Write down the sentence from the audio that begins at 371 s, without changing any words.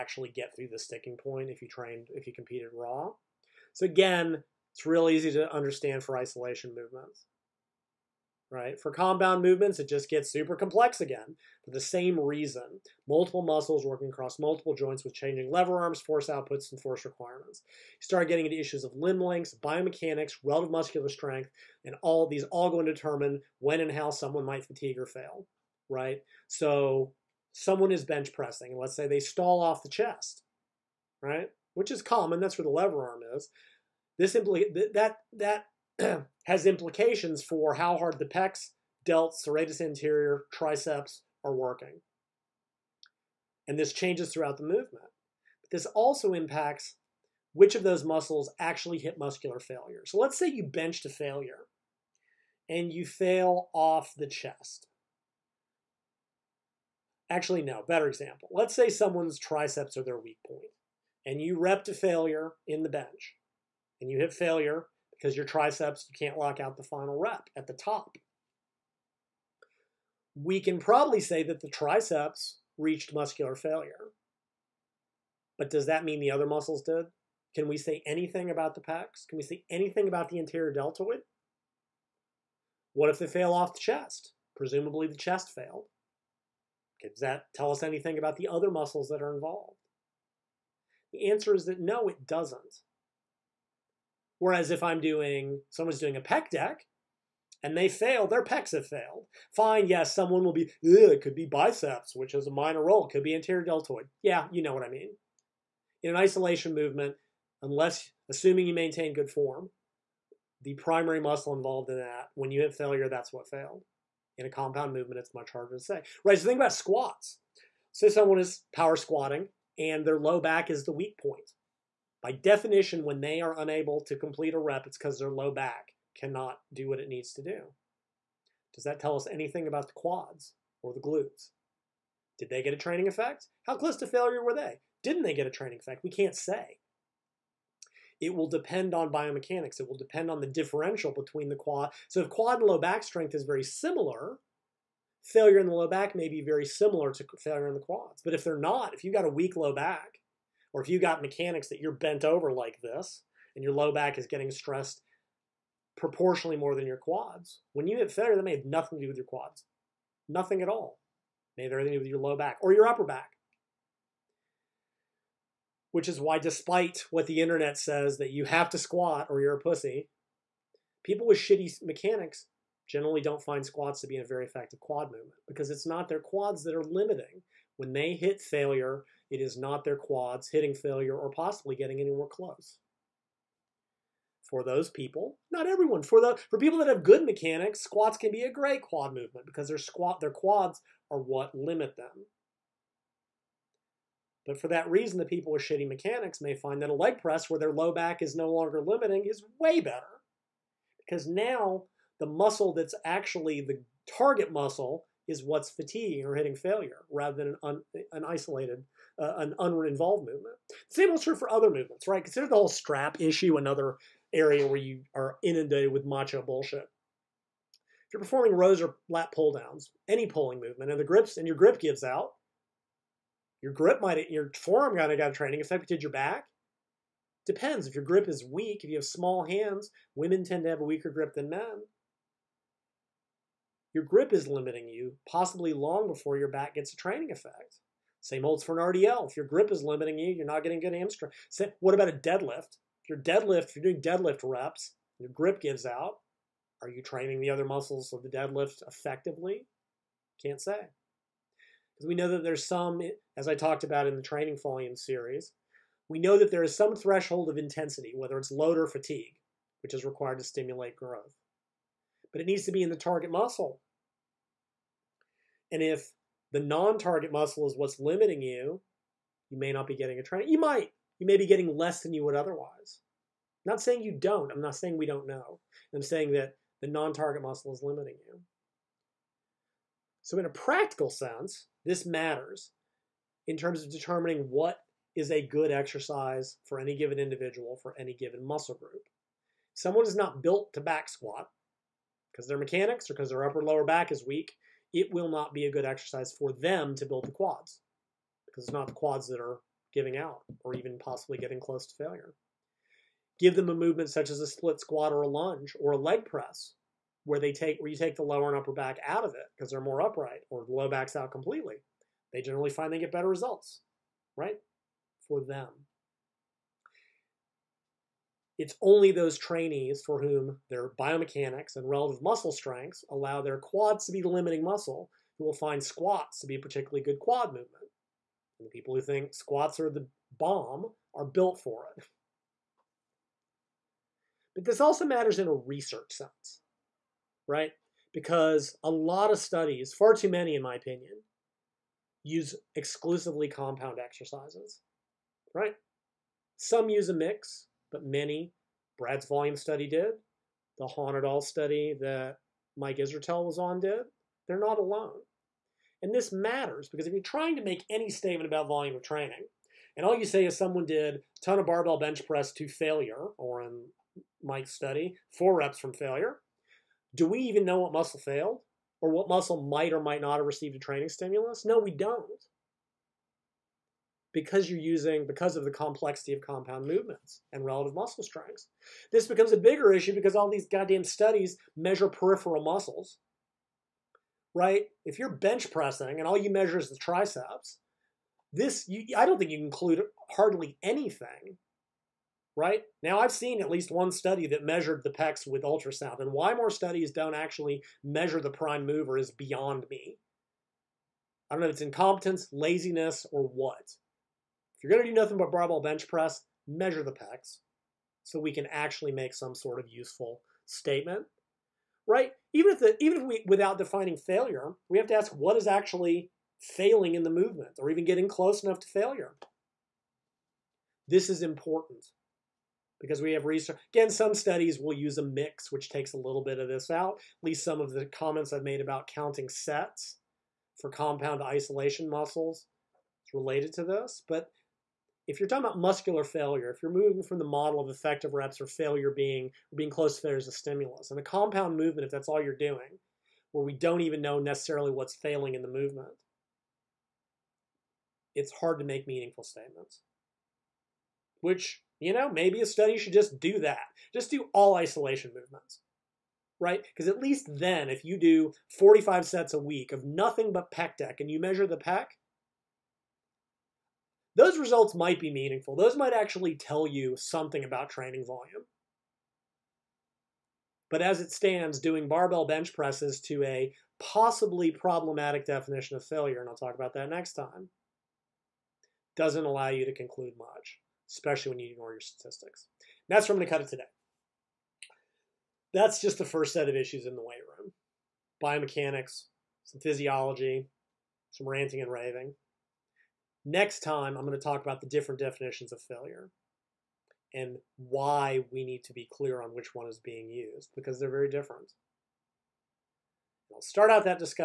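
No, we don't because you're using, because of the complexity of compound movements and relative muscle strengths.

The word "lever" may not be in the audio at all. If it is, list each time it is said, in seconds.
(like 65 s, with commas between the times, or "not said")
15 s, 32 s.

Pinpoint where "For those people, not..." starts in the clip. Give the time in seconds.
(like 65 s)
184 s.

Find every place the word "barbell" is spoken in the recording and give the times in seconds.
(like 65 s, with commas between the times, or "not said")
361 s, 405 s, 472 s.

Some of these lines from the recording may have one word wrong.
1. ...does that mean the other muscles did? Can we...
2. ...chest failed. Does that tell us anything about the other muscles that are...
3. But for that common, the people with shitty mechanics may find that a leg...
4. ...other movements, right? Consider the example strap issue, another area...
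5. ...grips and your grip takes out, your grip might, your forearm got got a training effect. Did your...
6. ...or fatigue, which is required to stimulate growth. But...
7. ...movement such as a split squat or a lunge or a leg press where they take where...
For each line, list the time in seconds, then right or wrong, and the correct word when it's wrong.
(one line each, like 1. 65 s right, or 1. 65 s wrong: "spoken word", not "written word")
1. 75 s right
2. 85 s right
3. 194 s wrong: "reason", not "common"
4. 211 s wrong: "whole", not "example"
5. 221 s wrong: "gives", not "takes"
6. 258 s right
7. 303 s right.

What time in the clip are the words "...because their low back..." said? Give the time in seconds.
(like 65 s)
124 s.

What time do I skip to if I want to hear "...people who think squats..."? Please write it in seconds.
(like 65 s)
328 s.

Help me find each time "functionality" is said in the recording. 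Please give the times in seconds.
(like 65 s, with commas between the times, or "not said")
not said.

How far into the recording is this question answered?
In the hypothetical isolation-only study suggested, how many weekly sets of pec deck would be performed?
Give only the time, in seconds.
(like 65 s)
458 s.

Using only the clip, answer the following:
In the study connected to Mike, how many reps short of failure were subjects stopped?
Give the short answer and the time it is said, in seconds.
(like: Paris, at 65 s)
4, at 365 s.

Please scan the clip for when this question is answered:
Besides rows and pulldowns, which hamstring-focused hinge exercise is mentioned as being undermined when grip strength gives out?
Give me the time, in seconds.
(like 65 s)
238 s.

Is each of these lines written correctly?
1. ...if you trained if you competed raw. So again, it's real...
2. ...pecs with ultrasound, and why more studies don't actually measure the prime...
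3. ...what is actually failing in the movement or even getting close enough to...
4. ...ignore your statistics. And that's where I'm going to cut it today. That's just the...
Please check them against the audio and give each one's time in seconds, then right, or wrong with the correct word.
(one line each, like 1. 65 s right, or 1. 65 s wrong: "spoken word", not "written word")
1. 1 s right
2. 395 s right
3. 415 s right
4. 481 s right.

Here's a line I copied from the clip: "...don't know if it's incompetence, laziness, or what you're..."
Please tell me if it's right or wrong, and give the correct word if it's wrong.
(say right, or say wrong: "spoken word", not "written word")
right.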